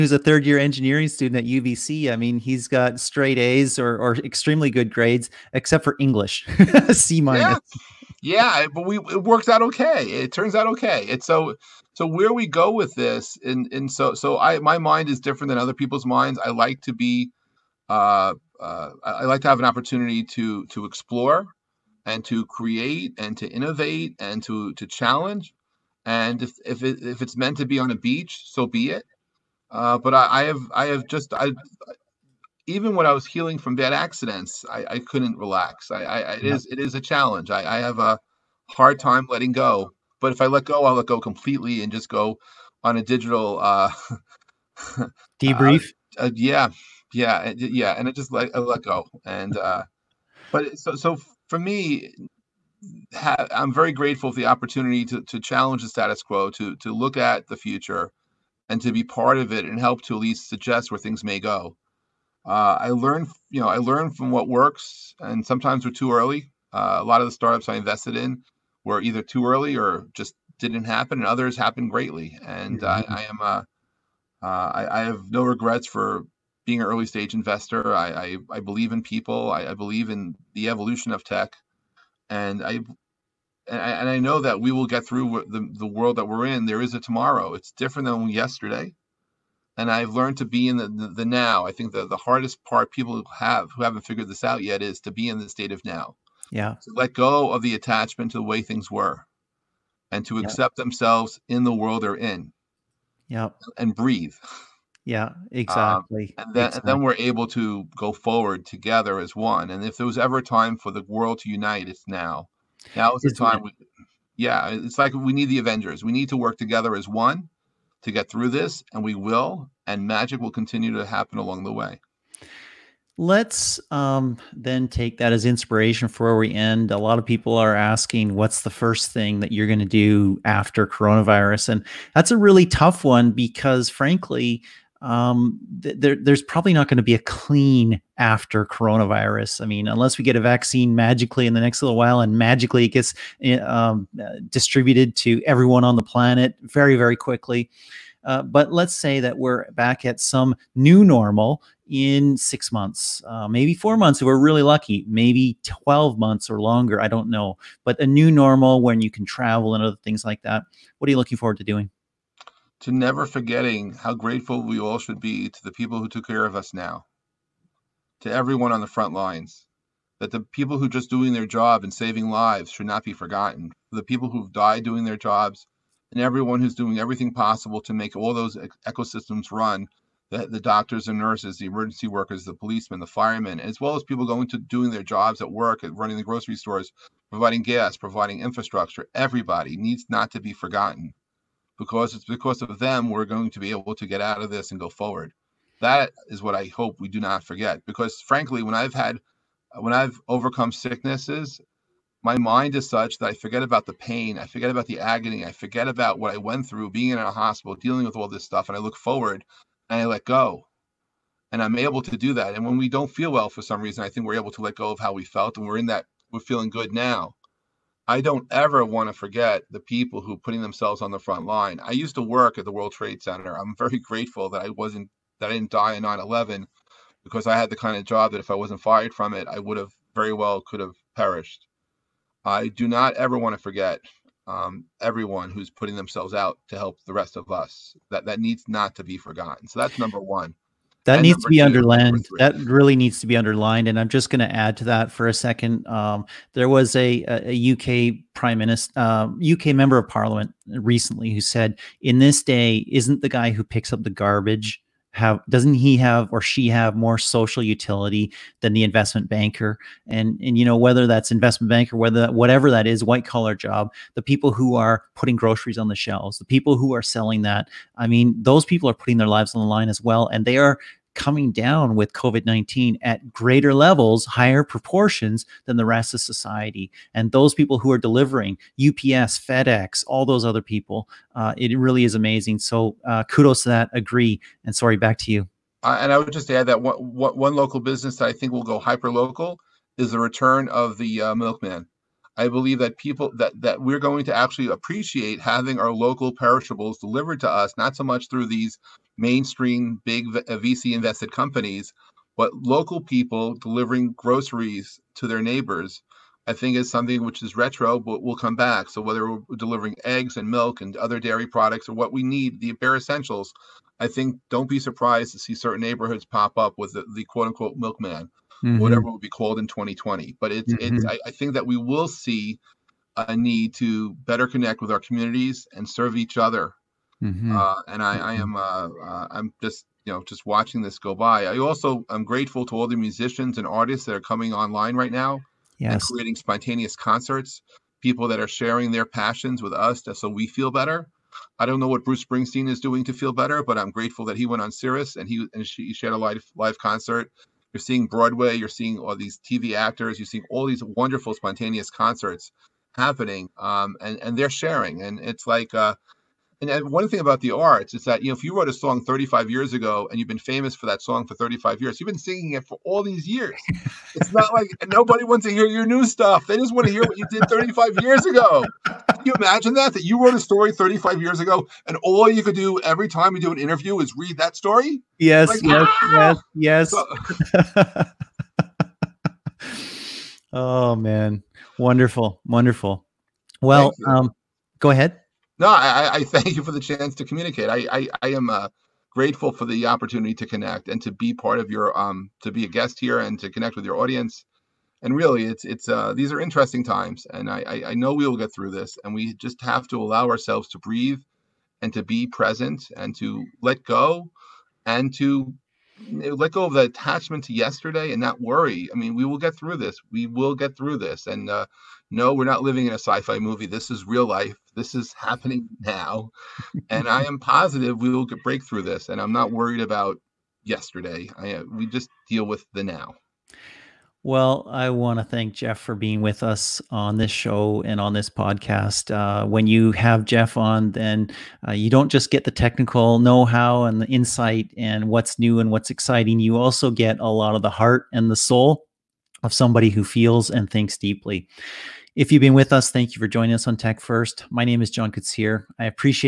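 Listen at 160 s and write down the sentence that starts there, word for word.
What are you looking forward to doing?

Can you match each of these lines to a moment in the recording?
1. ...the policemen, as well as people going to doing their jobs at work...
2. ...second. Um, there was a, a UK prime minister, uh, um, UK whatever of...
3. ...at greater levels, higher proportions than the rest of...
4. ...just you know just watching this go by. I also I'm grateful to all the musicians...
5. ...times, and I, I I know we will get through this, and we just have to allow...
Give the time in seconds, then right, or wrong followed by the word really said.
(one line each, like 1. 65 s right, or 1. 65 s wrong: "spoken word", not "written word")
1. 183 s wrong: "firemen", not "policemen"
2. 245 s wrong: "member", not "whatever"
3. 273 s right
4. 329 s right
5. 396 s right.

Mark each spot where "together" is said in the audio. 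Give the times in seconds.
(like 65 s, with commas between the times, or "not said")
108 s, 116 s.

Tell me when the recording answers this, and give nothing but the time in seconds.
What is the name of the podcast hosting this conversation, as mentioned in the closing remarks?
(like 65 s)
443 s.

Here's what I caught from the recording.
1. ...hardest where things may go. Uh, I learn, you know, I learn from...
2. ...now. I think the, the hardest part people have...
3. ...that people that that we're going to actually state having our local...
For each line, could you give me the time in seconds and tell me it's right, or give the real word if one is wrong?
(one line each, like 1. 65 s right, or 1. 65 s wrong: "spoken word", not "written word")
1. 60 s wrong: "suggest", not "hardest"
2. 91 s right
3. 292 s wrong: "appreciate", not "state".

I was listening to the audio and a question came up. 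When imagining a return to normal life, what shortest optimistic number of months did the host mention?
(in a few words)
4.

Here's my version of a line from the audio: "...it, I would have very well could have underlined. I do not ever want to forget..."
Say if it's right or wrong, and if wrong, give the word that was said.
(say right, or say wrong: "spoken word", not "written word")
wrong: "perished", not "underlined".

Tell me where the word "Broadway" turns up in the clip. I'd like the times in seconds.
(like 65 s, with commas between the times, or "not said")
348 s.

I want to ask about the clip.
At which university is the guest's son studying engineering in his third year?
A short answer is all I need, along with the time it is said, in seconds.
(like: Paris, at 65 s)
UBC, at 1 s.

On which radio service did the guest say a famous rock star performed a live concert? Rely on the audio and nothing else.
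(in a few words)
Sirius.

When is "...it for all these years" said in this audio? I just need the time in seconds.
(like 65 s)
362 s.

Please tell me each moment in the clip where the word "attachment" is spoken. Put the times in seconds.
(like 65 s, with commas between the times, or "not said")
97 s, 406 s.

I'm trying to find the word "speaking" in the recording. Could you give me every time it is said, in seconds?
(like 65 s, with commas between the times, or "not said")
not said.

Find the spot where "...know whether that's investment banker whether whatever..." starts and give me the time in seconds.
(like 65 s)
260 s.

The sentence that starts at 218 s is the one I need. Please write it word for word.
I don't ever want to forget the people who putting themselves on the front line.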